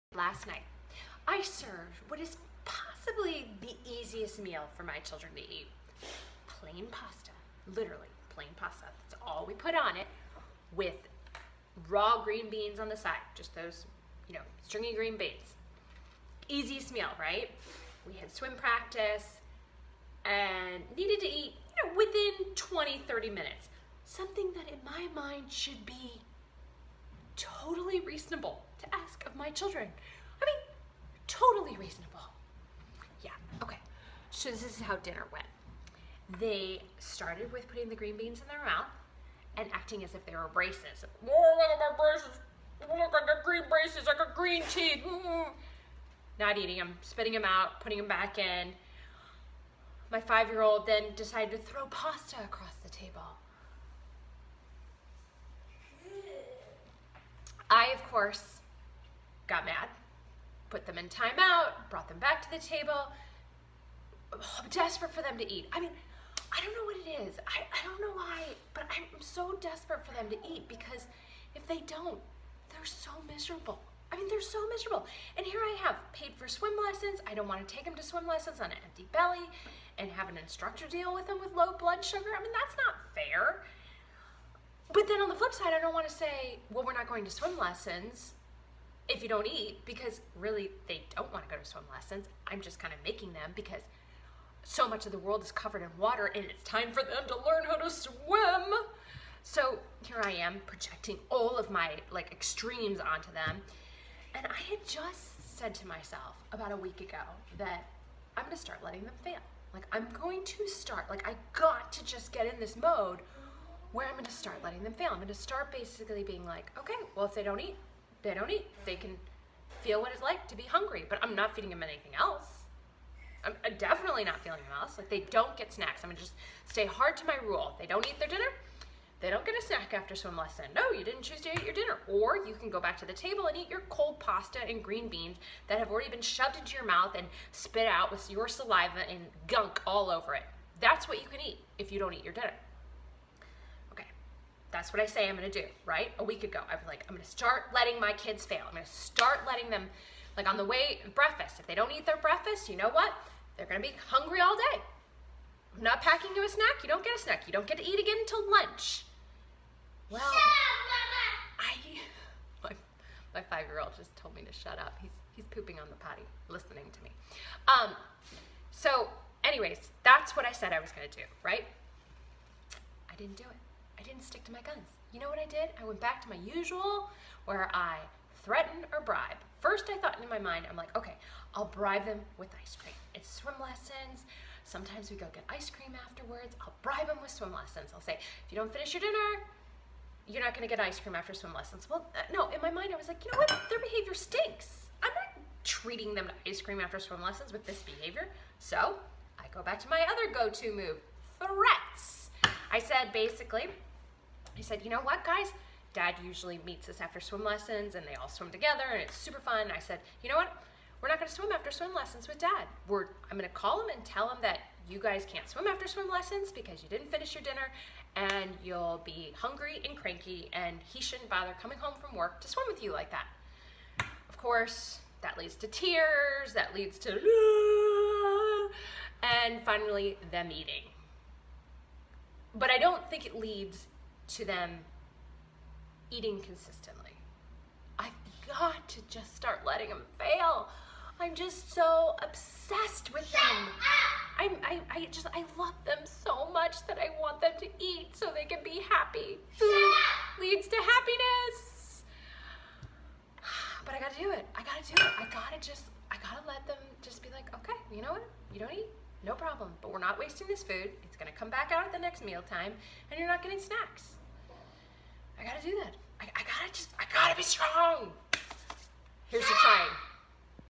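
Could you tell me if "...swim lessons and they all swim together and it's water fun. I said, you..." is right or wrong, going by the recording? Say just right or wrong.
wrong.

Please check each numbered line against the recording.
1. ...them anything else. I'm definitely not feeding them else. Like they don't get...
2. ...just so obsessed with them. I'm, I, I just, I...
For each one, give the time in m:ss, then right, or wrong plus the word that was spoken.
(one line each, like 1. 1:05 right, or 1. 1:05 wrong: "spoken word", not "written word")
1. 2:01 right
2. 4:01 right.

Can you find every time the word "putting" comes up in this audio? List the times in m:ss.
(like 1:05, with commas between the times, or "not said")
0:37, 0:47.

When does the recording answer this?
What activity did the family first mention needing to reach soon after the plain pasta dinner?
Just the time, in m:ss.
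0:18.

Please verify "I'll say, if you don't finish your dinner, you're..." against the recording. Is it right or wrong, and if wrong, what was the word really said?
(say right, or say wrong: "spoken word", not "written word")
right.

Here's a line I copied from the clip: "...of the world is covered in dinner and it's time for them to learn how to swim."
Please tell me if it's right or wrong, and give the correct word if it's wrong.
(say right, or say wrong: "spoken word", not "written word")
wrong: "water", not "dinner".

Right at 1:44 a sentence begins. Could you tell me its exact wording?
And I had just said to myself about a week ago that I'm gonna start letting them fail.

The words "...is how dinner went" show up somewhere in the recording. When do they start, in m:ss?
0:34.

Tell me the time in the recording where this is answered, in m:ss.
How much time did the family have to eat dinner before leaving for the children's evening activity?
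0:22.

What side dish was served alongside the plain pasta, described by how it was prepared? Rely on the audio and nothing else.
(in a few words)
Raw green beans.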